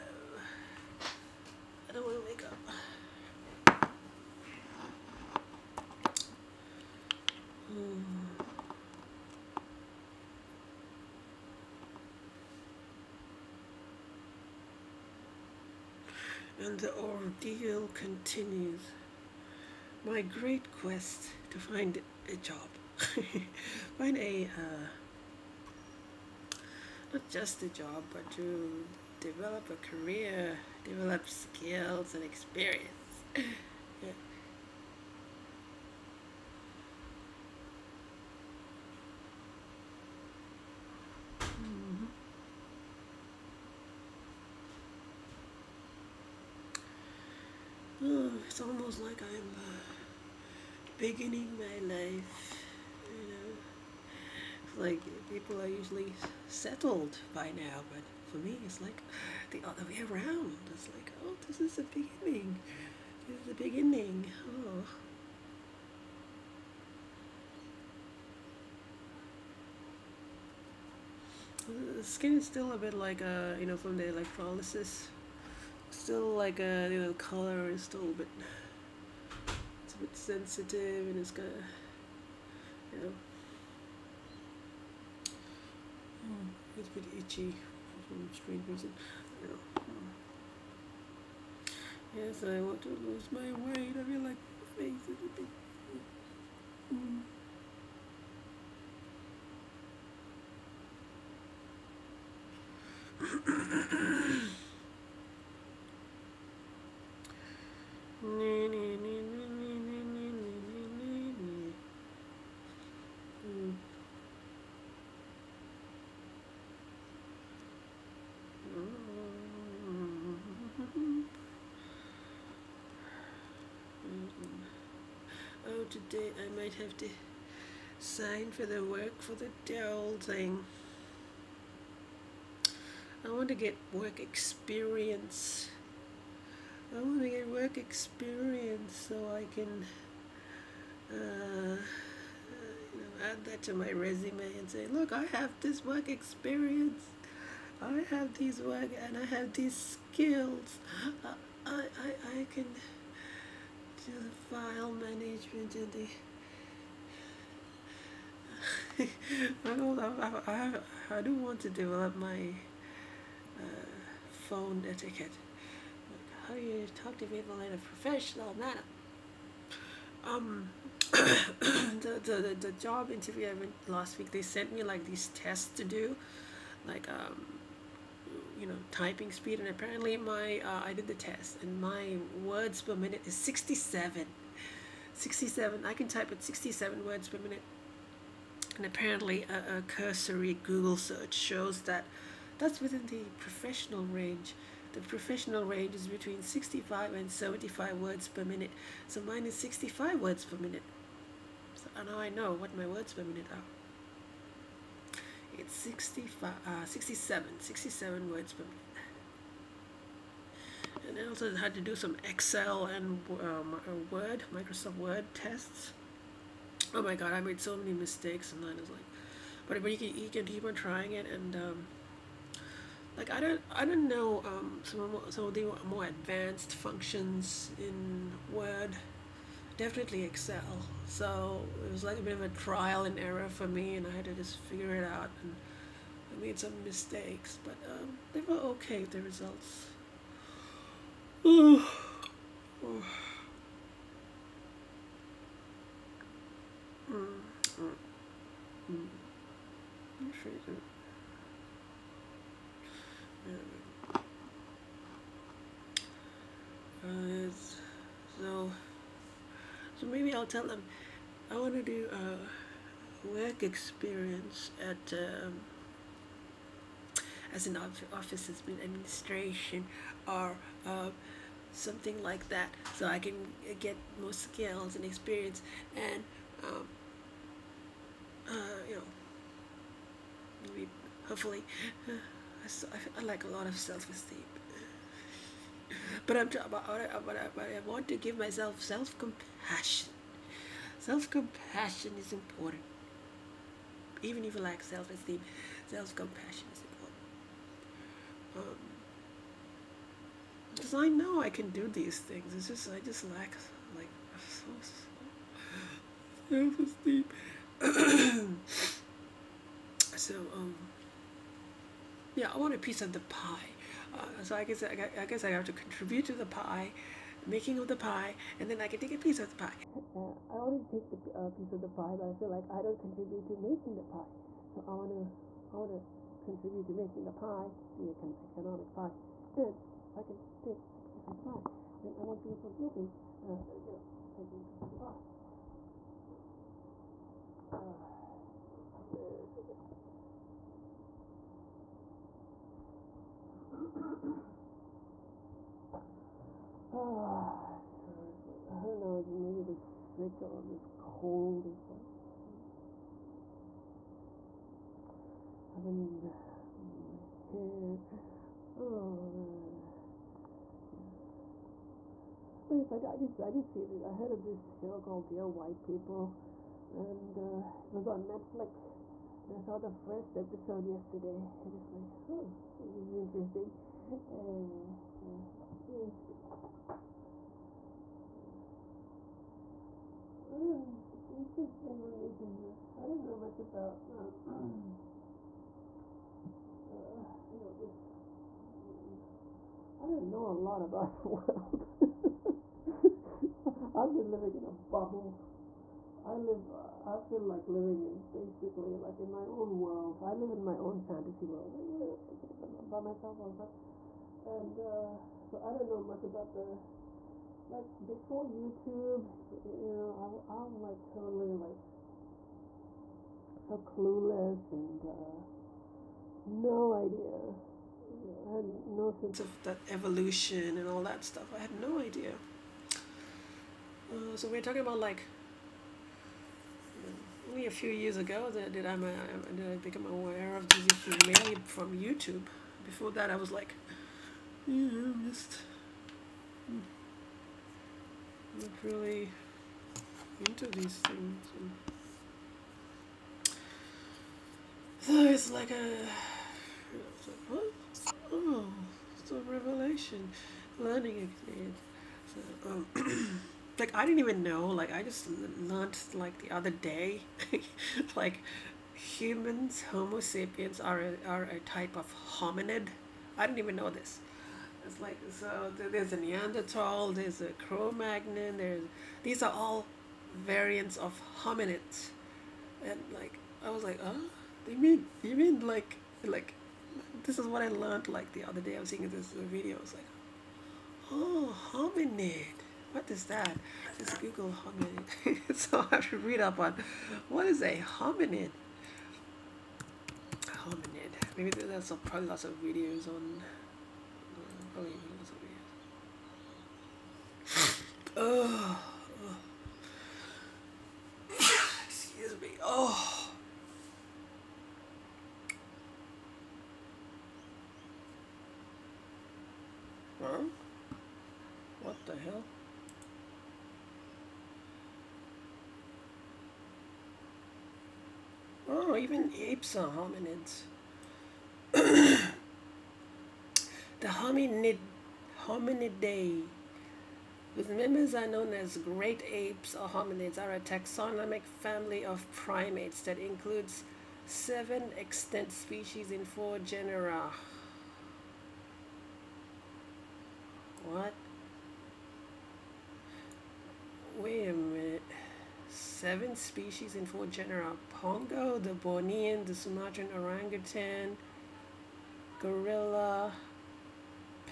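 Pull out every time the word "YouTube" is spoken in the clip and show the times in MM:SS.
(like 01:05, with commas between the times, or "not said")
06:48, 07:11.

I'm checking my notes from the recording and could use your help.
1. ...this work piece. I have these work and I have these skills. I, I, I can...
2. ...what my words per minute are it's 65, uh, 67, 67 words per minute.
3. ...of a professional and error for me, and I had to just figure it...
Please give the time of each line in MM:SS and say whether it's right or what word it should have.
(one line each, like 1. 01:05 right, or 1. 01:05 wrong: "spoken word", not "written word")
1. 02:25 wrong: "experience", not "piece"
2. 03:22 right
3. 03:52 wrong: "trial", not "professional".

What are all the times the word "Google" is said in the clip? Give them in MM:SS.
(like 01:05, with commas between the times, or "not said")
03:10, 08:04.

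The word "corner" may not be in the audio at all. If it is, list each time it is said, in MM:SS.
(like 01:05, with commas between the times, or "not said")
not said.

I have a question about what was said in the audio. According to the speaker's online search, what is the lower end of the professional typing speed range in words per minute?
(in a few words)
65.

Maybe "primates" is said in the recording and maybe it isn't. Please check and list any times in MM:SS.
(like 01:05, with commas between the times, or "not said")
08:52.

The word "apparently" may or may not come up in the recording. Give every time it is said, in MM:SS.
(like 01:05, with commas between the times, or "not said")
02:59, 03:08.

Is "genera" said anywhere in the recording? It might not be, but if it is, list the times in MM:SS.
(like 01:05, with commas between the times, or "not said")
08:56, 09:07.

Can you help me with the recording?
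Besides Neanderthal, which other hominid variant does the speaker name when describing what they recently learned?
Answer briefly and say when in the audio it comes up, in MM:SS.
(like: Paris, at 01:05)
Cro-Magnon, at 07:47.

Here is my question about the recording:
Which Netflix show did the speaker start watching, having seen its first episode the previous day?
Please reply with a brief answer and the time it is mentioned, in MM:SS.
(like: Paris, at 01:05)
Dear White People, at 06:05.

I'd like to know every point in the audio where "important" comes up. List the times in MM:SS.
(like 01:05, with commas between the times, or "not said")
04:52, 04:56.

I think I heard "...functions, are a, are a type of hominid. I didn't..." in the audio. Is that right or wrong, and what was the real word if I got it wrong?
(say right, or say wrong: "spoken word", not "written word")
wrong: "sapiens", not "functions".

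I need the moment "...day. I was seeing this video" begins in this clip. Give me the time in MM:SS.
07:58.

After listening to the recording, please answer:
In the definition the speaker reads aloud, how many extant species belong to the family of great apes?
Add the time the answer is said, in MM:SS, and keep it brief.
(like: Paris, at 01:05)
7, at 08:54.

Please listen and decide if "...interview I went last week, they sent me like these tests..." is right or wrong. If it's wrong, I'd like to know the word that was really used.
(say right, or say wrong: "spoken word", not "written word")
right.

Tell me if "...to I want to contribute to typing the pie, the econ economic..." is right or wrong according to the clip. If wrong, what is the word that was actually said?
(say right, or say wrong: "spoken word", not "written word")
wrong: "making", not "typing".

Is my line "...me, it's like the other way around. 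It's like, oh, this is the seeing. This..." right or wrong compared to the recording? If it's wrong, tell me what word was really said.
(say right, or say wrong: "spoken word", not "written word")
wrong: "beginning", not "seeing".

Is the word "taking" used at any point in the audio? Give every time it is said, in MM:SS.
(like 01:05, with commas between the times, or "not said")
05:34.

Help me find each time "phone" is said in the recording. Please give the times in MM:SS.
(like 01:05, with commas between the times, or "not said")
02:44.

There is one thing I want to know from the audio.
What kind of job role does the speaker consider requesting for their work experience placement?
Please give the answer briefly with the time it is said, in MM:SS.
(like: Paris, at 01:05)
Office administration, at 04:28.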